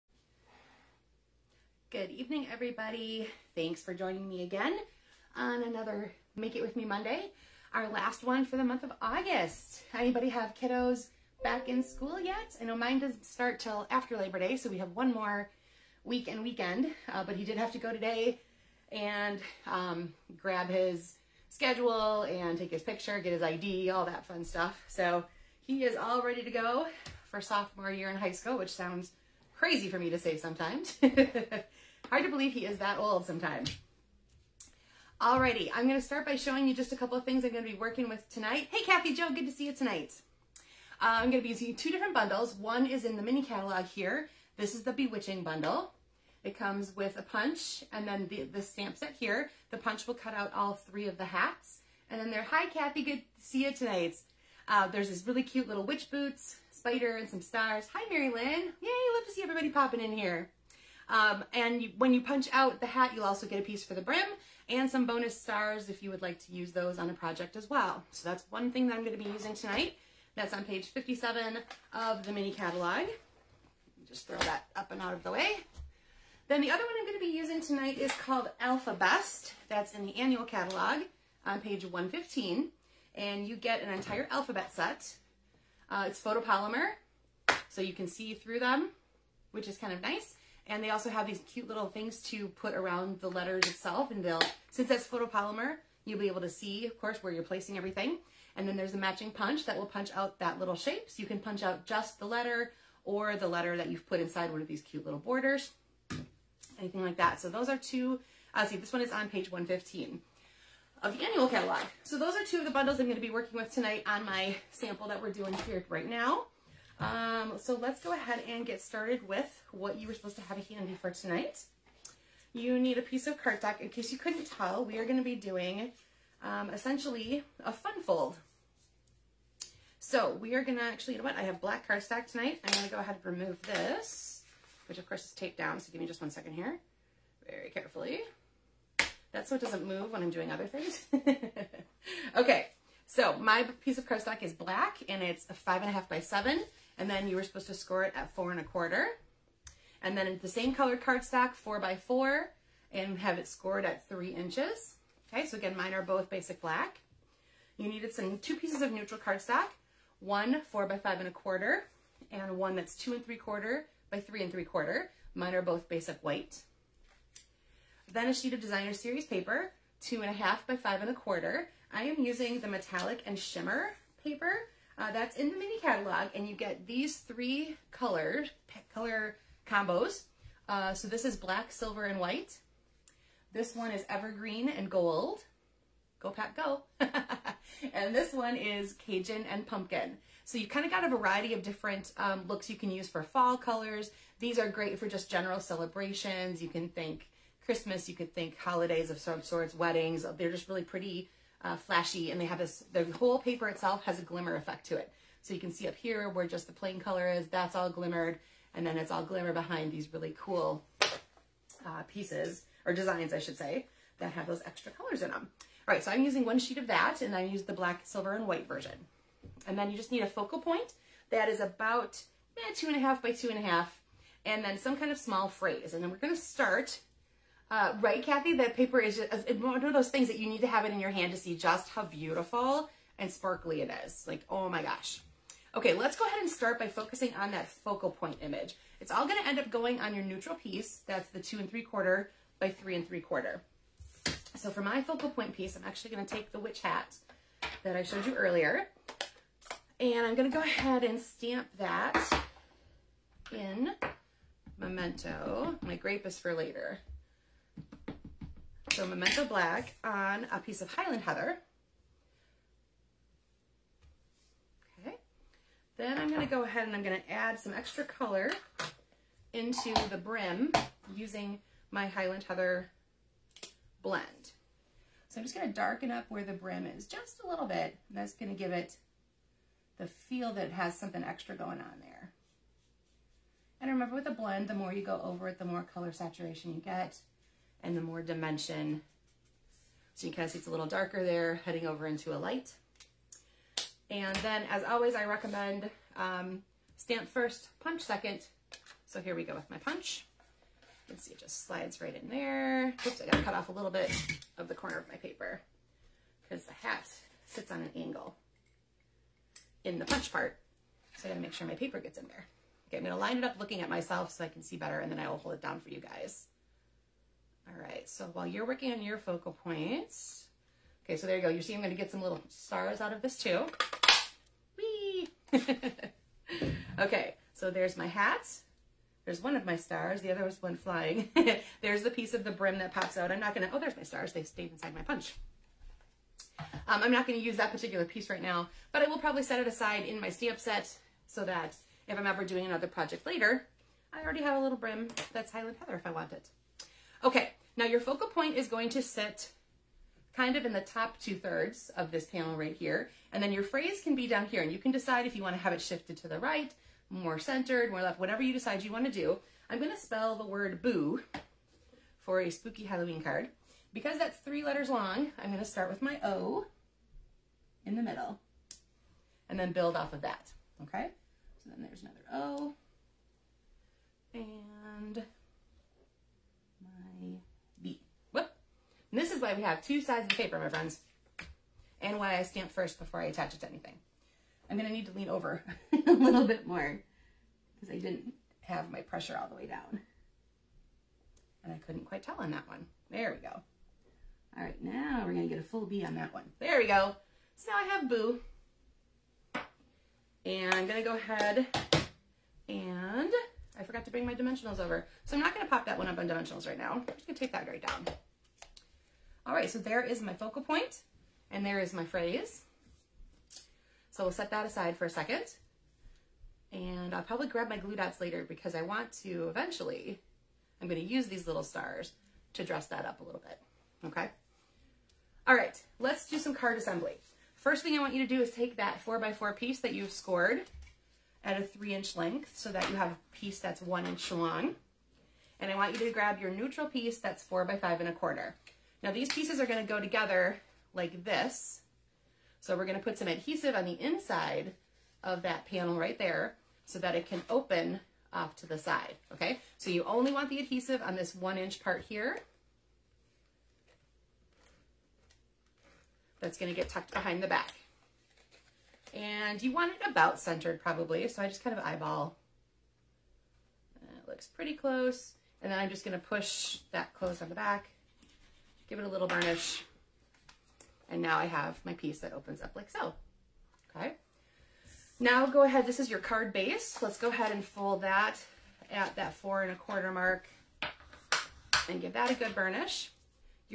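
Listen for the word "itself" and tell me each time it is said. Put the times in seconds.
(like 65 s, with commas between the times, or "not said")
93 s, 203 s.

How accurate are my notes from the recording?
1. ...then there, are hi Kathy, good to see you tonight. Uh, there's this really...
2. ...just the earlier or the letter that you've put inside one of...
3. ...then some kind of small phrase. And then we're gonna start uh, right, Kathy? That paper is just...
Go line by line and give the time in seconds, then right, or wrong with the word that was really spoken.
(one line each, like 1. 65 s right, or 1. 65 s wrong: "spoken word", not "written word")
1. 52 s right
2. 101 s wrong: "letter", not "earlier"
3. 224 s right.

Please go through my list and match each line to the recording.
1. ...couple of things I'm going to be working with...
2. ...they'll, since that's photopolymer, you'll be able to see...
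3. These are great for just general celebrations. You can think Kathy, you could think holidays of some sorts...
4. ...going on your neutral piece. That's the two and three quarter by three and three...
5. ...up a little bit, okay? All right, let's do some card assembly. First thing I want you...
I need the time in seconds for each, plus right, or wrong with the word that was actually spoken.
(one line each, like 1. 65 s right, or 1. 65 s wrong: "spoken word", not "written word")
1. 36 s right
2. 94 s right
3. 194 s wrong: "Christmas", not "Kathy"
4. 239 s right
5. 423 s right.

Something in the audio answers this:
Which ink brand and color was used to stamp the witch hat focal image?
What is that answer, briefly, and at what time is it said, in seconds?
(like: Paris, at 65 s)
Memento Black, at 259 s.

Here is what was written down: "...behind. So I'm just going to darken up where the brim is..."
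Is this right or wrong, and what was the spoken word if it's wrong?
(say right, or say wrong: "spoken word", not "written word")
wrong: "blend", not "behind".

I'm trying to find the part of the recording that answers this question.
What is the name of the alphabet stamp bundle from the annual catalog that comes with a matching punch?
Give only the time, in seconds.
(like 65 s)
78 s.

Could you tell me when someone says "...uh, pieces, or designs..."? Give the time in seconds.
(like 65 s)
211 s.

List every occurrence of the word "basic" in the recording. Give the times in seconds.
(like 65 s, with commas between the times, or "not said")
156 s, 165 s.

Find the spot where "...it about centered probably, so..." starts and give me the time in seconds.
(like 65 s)
459 s.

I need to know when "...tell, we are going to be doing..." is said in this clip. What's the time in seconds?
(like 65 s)
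124 s.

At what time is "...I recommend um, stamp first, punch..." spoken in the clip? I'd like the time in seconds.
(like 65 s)
295 s.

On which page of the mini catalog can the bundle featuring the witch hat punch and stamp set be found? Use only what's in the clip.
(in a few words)
57.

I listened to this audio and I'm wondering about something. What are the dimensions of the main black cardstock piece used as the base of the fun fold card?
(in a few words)
5 1/2 by 7.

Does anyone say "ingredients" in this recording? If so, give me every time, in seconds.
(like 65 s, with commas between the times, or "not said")
not said.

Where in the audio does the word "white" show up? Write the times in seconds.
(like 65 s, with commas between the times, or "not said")
166 s, 182 s, 218 s.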